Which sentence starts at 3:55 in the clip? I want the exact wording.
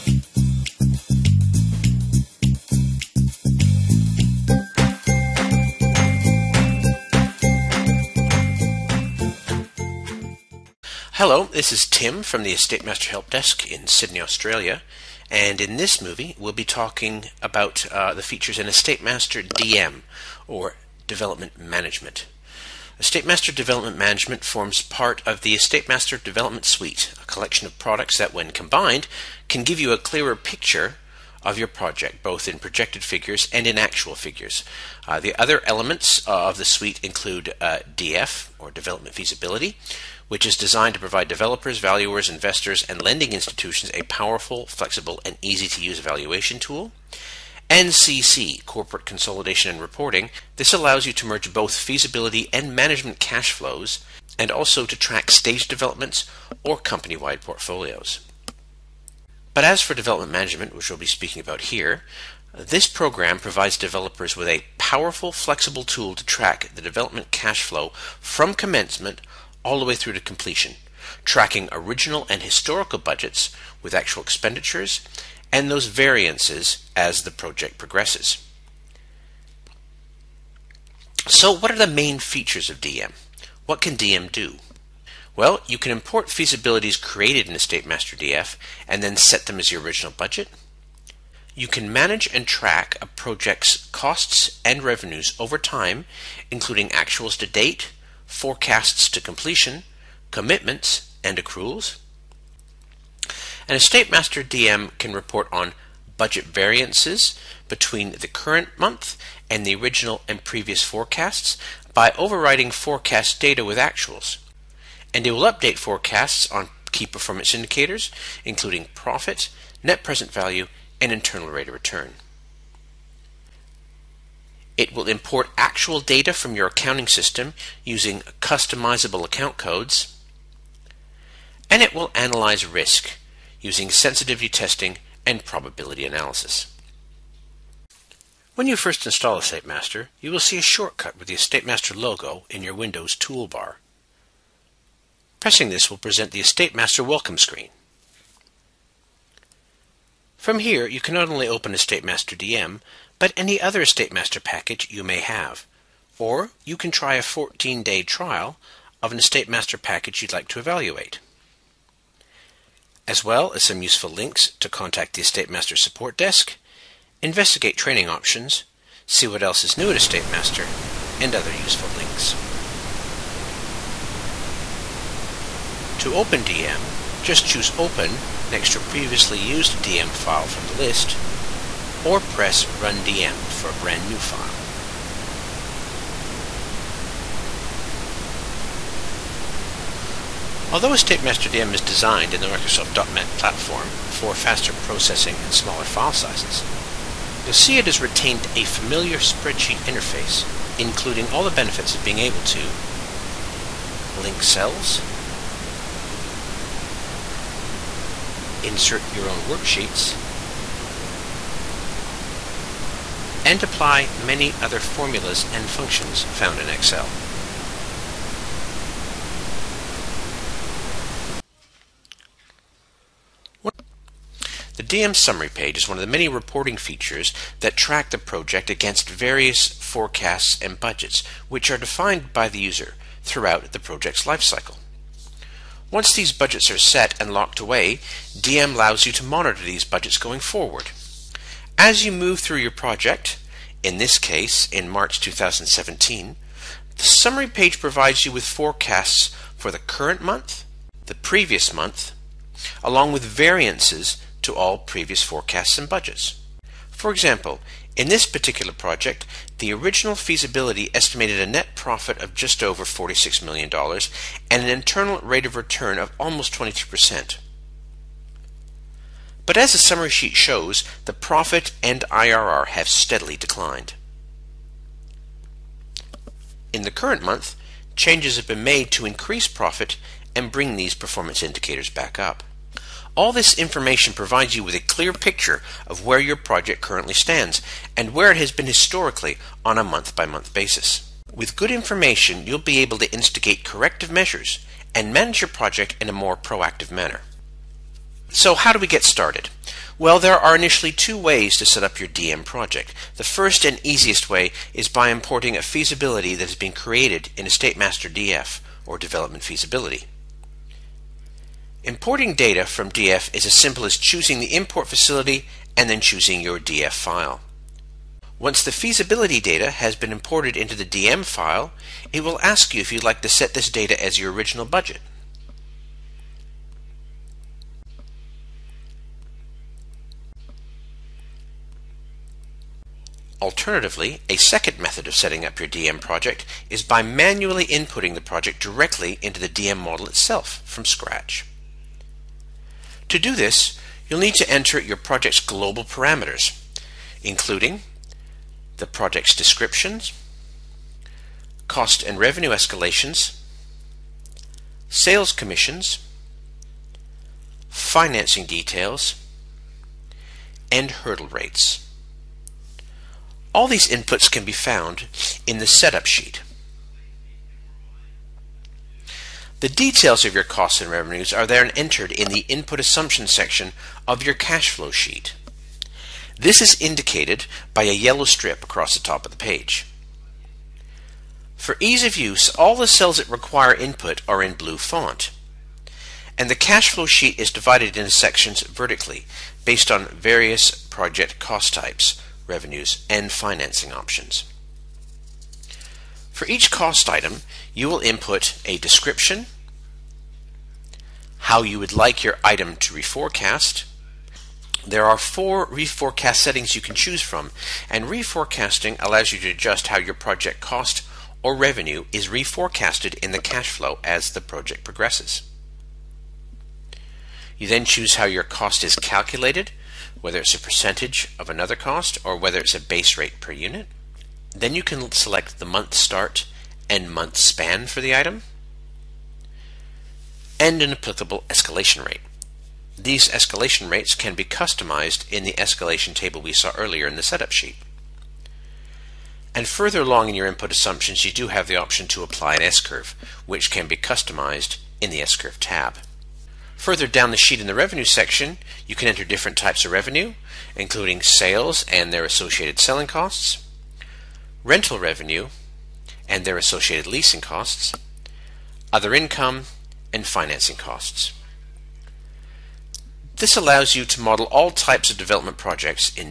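Once these budgets are set and locked away, DM allows you to monitor these budgets going forward.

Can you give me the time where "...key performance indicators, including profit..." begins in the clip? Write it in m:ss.
1:56.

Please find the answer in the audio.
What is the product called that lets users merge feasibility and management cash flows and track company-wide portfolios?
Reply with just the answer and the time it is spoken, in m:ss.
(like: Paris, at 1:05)
Corporate Consolidation and Reporting, at 0:48.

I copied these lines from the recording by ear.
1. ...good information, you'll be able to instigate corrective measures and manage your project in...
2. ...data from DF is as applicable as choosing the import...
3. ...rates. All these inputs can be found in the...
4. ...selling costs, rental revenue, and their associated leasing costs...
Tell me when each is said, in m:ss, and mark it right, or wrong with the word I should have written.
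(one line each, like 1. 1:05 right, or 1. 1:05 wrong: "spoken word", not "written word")
1. 4:51 right
2. 5:12 wrong: "simple", not "applicable"
3. 6:01 right
4. 7:32 right.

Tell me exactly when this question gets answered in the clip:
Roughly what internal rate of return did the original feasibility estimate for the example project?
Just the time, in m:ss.
4:26.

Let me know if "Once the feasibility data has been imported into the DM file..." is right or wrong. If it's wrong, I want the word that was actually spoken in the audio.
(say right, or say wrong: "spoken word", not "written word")
right.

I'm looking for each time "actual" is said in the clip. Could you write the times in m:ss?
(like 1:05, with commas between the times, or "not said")
0:33, 1:13, 1:36, 1:53, 2:05.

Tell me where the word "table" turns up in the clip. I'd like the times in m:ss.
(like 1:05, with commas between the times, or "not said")
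7:16.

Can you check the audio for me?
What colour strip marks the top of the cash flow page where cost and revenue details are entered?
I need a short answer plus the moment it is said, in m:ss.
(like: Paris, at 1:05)
Yellow, at 6:17.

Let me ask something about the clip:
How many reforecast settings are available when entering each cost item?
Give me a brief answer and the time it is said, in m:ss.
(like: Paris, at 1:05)
4, at 6:45.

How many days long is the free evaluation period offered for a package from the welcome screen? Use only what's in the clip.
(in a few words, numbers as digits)
14 days.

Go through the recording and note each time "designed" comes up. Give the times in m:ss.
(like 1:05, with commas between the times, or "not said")
0:40, 3:11.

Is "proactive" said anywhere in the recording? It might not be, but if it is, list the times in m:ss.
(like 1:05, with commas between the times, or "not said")
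4:56.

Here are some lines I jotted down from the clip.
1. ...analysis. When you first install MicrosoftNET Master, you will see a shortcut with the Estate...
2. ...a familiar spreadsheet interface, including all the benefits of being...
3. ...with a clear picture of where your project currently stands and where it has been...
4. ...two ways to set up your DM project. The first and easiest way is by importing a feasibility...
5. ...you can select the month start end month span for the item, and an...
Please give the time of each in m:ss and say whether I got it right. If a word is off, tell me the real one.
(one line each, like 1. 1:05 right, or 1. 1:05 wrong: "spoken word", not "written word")
1. 2:16 wrong: "Estate", not "MicrosoftNET"
2. 3:18 right
3. 4:44 right
4. 5:00 right
5. 7:04 right.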